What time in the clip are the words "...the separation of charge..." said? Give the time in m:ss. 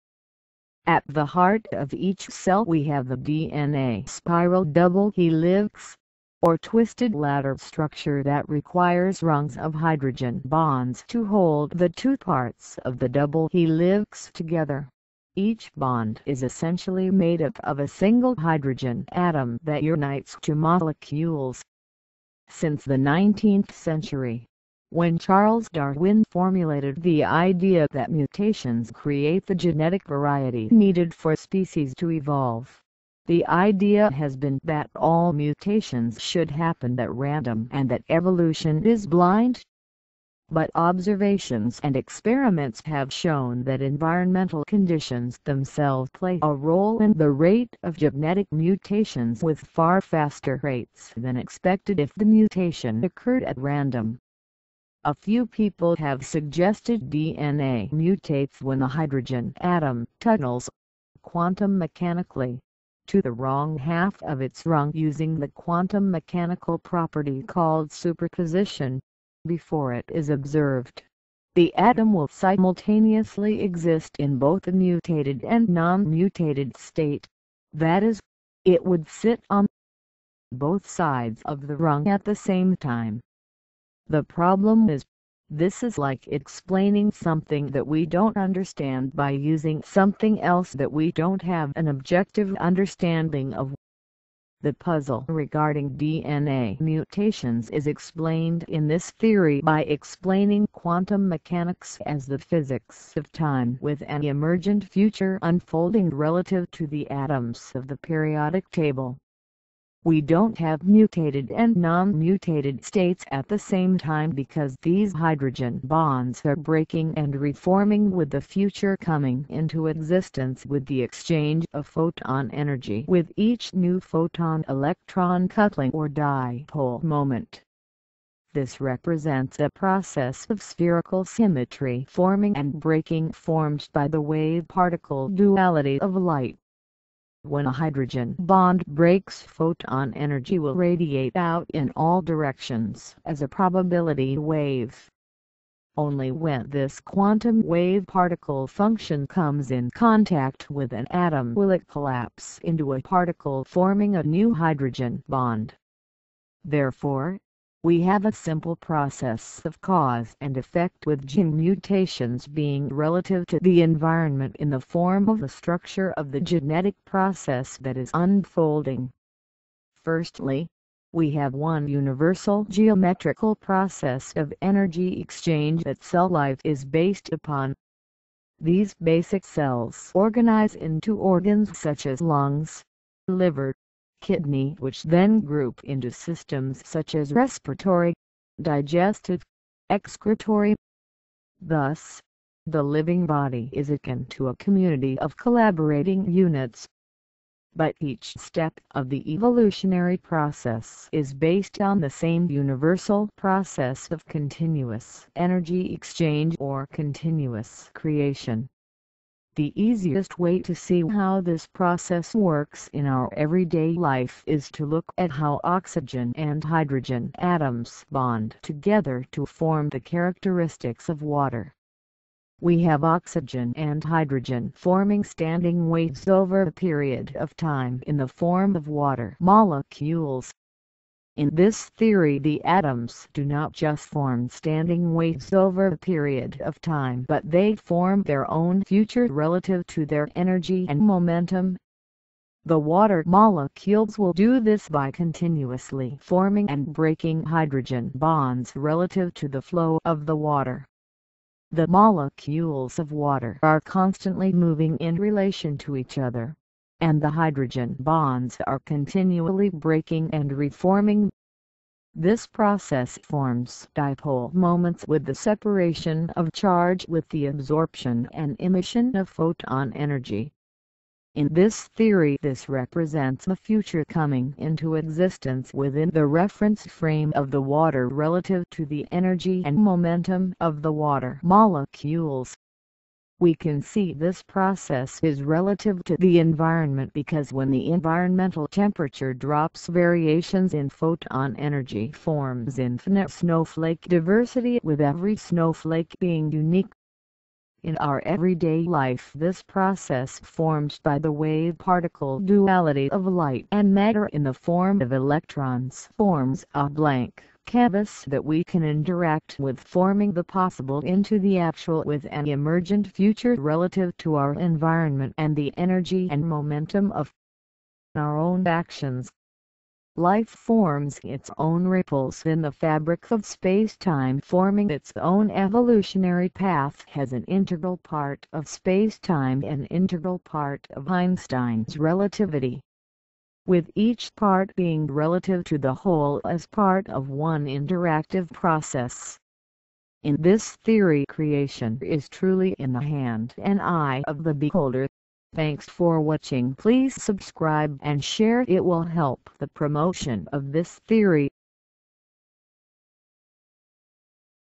4:25.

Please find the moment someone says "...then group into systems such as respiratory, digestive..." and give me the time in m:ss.
3:05.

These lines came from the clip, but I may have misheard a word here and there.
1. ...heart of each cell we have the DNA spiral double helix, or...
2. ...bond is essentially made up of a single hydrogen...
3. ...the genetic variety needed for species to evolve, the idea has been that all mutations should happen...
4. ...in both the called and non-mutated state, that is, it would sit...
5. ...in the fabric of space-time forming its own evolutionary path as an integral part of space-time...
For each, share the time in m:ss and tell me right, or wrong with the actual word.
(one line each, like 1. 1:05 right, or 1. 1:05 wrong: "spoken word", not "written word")
1. 0:01 right
2. 0:15 right
3. 0:29 right
4. 1:14 wrong: "mutated", not "called"
5. 5:22 right.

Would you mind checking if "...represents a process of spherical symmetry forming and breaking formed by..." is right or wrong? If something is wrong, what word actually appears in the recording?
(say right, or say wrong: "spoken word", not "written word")
right.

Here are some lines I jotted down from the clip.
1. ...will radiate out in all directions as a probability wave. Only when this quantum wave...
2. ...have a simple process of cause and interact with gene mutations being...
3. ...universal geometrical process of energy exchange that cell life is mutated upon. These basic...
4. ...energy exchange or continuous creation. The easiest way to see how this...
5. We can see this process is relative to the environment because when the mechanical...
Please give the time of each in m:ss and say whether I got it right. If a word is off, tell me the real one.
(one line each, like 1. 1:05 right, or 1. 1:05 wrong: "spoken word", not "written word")
1. 2:20 right
2. 2:38 wrong: "effect", not "interact"
3. 2:51 wrong: "based", not "mutated"
4. 3:25 right
5. 4:43 wrong: "environmental", not "mechanical".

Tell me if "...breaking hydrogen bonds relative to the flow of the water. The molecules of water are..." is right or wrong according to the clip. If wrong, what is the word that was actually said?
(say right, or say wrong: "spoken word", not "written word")
right.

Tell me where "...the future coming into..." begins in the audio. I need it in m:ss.
1:58.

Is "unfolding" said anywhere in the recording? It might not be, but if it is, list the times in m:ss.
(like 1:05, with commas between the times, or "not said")
1:45, 2:48.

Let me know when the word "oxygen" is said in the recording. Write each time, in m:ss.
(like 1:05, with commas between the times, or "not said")
3:35, 3:43.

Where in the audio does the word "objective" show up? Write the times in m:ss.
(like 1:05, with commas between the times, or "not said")
1:31.